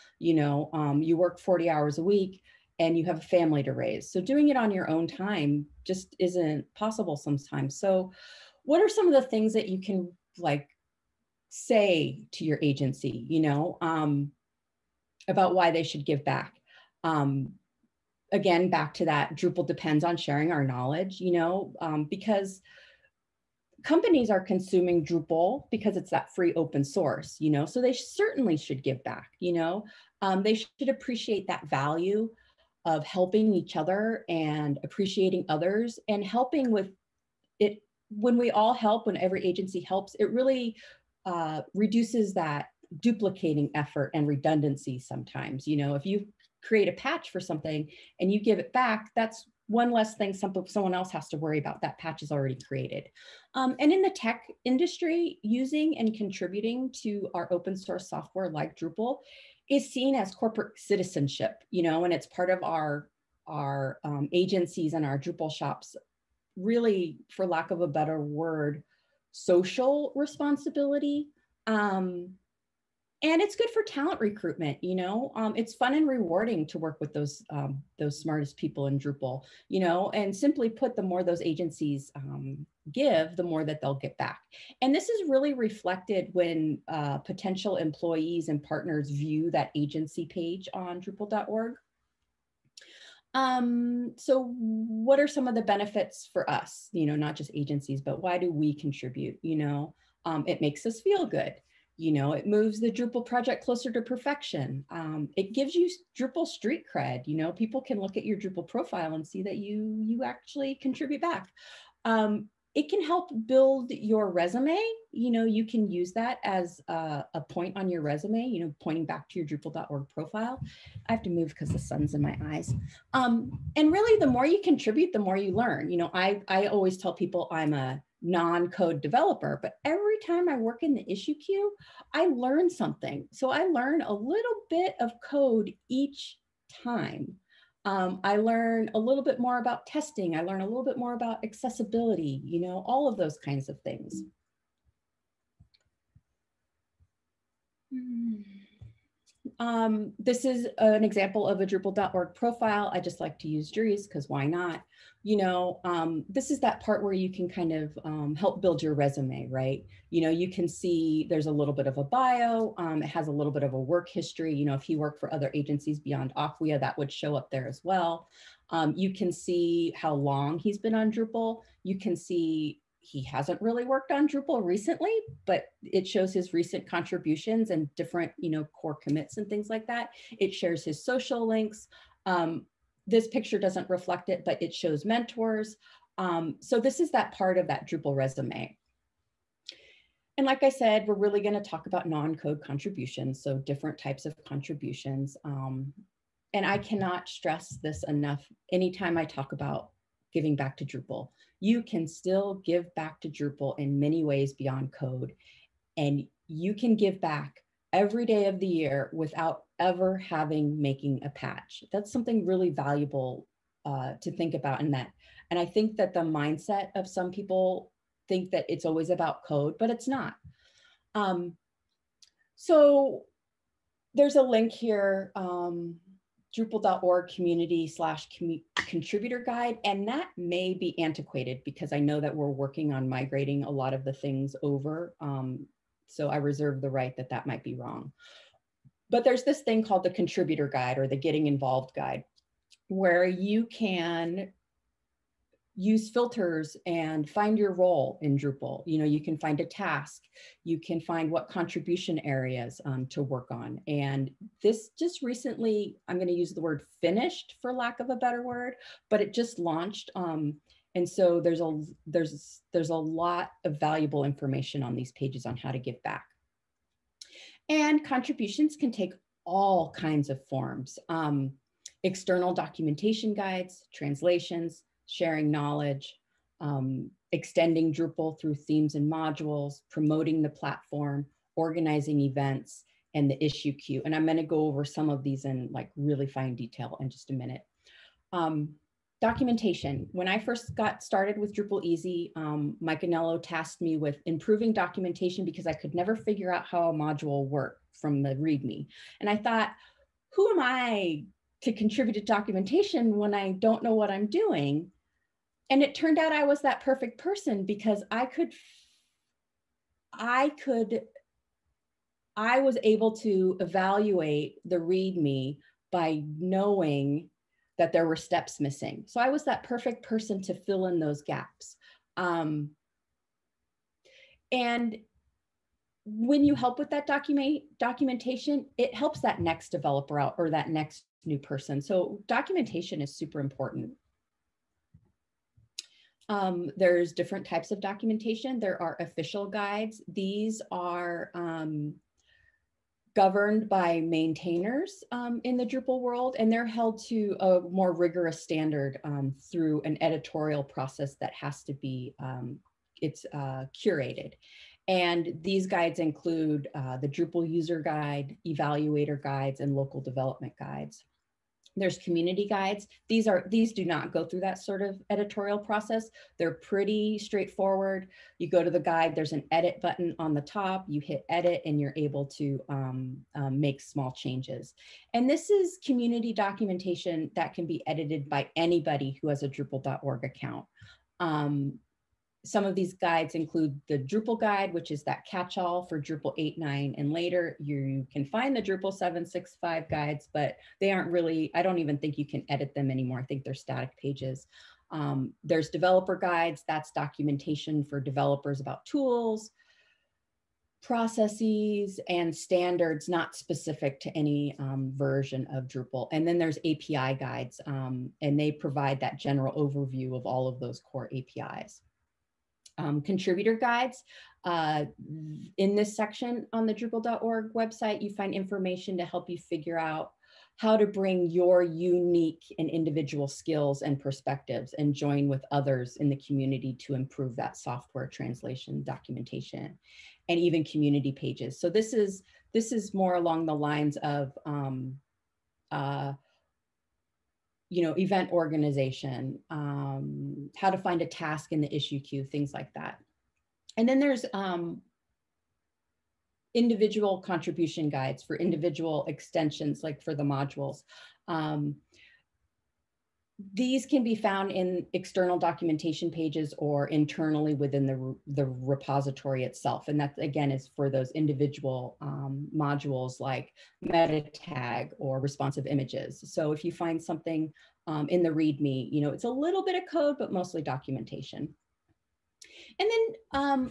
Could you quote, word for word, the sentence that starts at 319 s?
So I was that perfect person to fill in those gaps.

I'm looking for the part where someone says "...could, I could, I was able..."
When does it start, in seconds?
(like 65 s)
308 s.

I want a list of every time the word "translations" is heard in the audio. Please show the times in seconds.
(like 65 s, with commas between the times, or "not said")
273 s, 428 s.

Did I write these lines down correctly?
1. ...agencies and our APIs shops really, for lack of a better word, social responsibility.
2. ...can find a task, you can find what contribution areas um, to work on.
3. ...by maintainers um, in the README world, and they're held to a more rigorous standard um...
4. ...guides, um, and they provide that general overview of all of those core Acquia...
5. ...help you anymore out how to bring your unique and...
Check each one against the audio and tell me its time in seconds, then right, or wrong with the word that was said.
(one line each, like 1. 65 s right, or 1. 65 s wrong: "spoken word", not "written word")
1. 64 s wrong: "Drupal", not "APIs"
2. 249 s right
3. 343 s wrong: "Drupal", not "README"
4. 407 s wrong: "APIs", not "Acquia"
5. 419 s wrong: "figure", not "anymore".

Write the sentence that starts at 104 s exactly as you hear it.
Um, it gives you Drupal street cred.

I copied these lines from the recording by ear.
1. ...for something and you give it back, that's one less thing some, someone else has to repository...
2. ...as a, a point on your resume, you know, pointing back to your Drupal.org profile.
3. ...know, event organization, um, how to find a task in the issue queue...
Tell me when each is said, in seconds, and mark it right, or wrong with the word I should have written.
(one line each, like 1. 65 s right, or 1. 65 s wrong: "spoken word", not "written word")
1. 47 s wrong: "worry", not "repository"
2. 116 s right
3. 437 s right.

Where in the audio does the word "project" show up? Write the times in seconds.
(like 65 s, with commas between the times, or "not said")
103 s.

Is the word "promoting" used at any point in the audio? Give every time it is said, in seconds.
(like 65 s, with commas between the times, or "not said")
279 s.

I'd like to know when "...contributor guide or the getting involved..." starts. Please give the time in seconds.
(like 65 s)
240 s.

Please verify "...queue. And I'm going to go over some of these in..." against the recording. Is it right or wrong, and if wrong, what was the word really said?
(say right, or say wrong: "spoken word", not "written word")
right.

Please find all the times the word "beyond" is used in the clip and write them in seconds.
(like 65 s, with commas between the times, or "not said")
165 s, 204 s.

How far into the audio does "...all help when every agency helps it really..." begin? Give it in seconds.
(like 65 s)
38 s.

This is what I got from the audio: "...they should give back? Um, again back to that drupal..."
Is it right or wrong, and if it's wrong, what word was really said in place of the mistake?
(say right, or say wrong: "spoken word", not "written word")
right.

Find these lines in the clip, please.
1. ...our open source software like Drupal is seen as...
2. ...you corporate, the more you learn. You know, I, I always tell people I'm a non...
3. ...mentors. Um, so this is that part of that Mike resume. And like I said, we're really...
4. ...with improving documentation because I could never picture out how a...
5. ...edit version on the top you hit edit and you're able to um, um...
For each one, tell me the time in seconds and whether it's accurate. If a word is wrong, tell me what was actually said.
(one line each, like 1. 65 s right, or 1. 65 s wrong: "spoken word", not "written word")
1. 57 s right
2. 124 s wrong: "contribute", not "corporate"
3. 185 s wrong: "Drupal", not "Mike"
4. 293 s wrong: "figure", not "picture"
5. 369 s wrong: "button", not "version".